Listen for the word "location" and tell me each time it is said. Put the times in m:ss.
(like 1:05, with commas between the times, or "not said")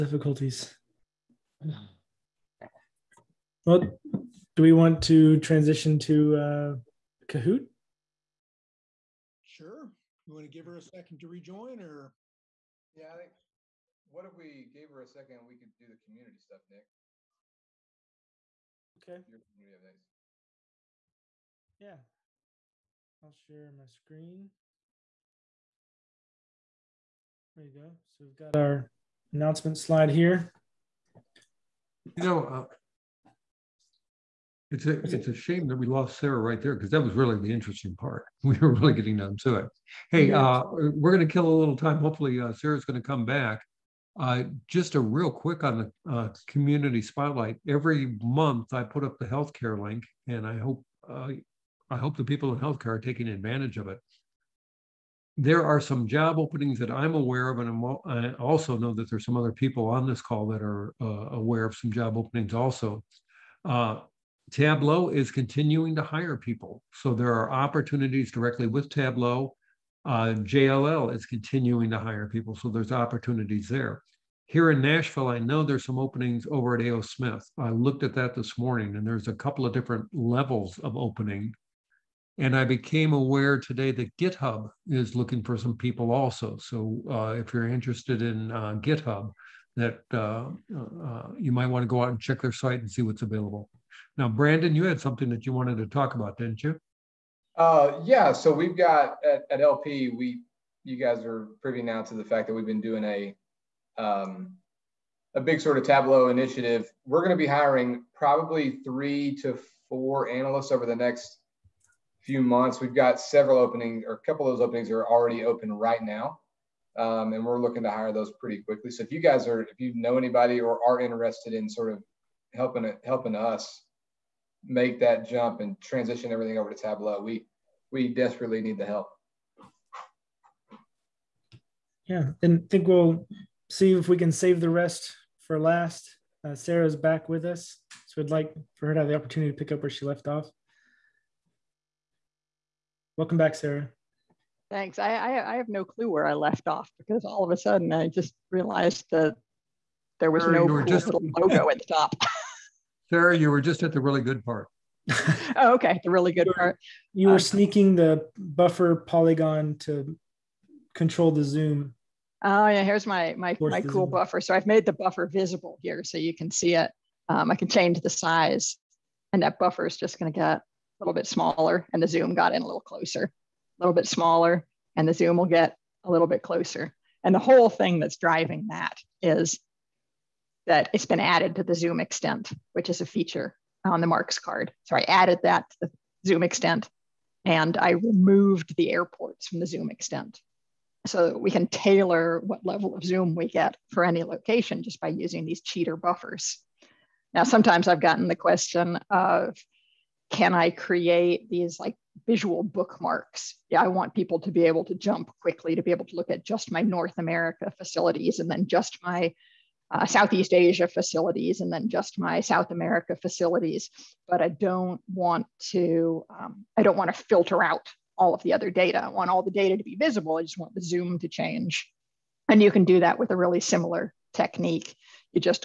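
3:14.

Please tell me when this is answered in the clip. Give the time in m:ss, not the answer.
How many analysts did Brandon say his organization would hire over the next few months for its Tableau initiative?
1:48.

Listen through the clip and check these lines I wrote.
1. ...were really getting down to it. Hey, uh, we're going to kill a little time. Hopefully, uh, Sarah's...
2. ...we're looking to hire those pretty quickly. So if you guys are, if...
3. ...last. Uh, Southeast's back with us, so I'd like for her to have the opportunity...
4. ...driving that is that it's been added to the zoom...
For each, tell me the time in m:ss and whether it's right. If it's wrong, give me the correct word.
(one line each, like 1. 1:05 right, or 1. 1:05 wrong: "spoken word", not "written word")
1. 0:38 right
2. 1:57 right
3. 2:15 wrong: "Sarah", not "Southeast"
4. 2:58 right.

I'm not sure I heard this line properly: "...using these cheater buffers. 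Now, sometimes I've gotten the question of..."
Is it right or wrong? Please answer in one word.
right.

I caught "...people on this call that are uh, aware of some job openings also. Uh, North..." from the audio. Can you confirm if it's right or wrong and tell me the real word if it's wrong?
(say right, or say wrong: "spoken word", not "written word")
wrong: "Tableau", not "North".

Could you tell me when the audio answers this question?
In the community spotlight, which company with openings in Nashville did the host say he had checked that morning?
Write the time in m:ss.
1:16.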